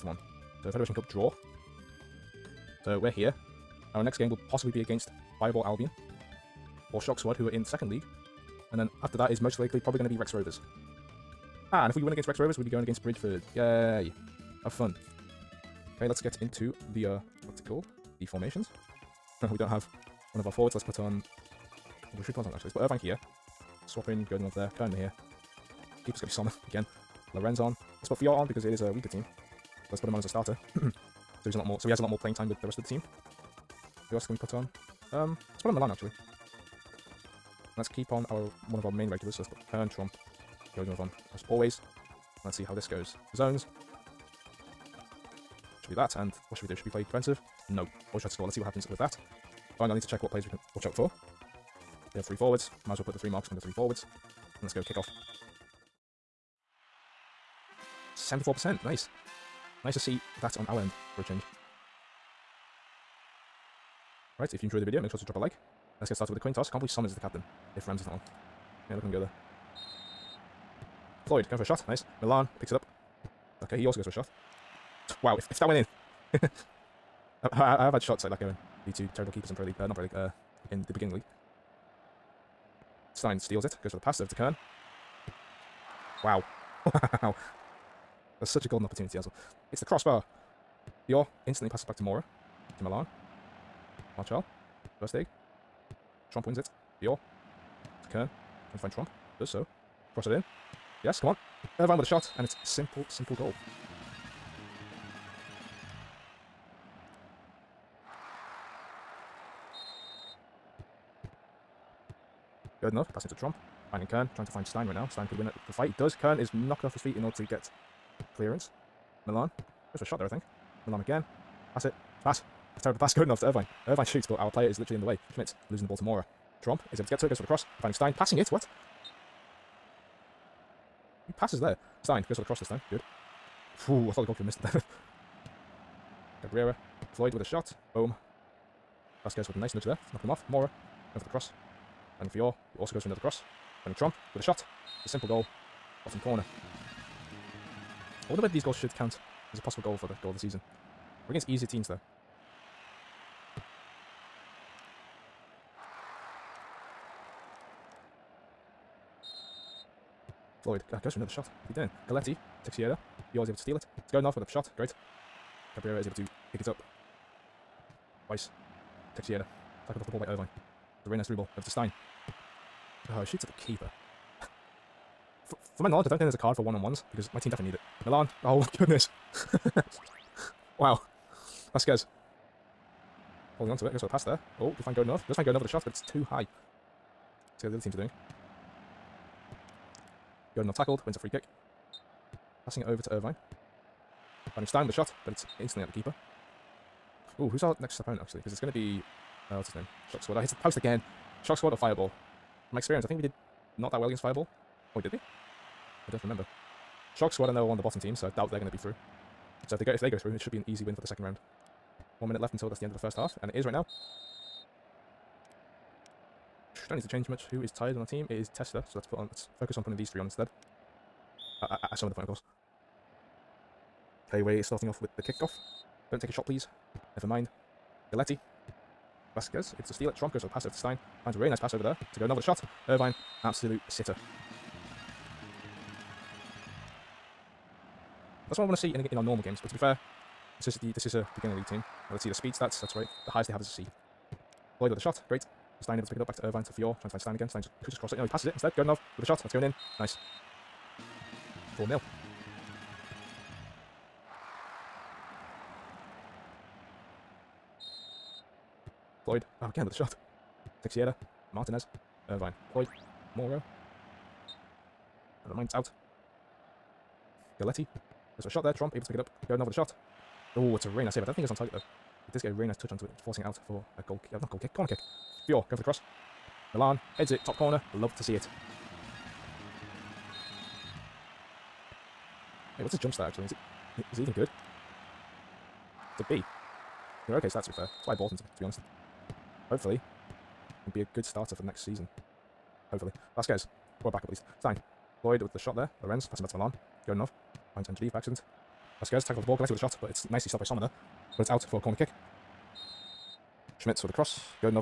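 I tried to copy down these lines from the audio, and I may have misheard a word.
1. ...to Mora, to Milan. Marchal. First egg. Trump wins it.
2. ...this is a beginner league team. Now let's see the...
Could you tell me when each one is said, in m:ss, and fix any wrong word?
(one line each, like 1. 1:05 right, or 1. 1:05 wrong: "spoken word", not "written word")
1. 1:31 right
2. 4:00 right.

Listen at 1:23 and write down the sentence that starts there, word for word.
Stein steals it, goes for the pass over to Kern.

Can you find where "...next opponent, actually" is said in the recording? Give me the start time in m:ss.
3:17.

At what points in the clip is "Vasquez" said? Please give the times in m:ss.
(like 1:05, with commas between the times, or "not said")
2:19, 3:49, 4:53, 4:59.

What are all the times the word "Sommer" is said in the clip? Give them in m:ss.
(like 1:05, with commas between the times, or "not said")
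5:00.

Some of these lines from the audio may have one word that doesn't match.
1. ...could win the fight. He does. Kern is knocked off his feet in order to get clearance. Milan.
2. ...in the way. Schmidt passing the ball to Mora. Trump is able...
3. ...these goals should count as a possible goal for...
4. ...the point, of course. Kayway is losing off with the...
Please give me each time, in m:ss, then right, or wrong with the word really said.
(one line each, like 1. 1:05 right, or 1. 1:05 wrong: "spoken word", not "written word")
1. 1:55 right
2. 2:04 wrong: "losing", not "passing"
3. 2:28 right
4. 3:42 wrong: "starting", not "losing".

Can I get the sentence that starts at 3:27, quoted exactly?
Shock Squad, I know, are one of the bottom teams, so I doubt they're going to be through.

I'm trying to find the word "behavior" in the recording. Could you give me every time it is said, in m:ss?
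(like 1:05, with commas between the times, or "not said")
not said.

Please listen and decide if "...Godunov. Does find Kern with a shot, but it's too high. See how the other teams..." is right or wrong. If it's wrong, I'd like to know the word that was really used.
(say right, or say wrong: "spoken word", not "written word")
wrong: "Godunov", not "Kern".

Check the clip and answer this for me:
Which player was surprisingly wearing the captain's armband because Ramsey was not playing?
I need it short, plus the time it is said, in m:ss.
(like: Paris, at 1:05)
Summers, at 1:06.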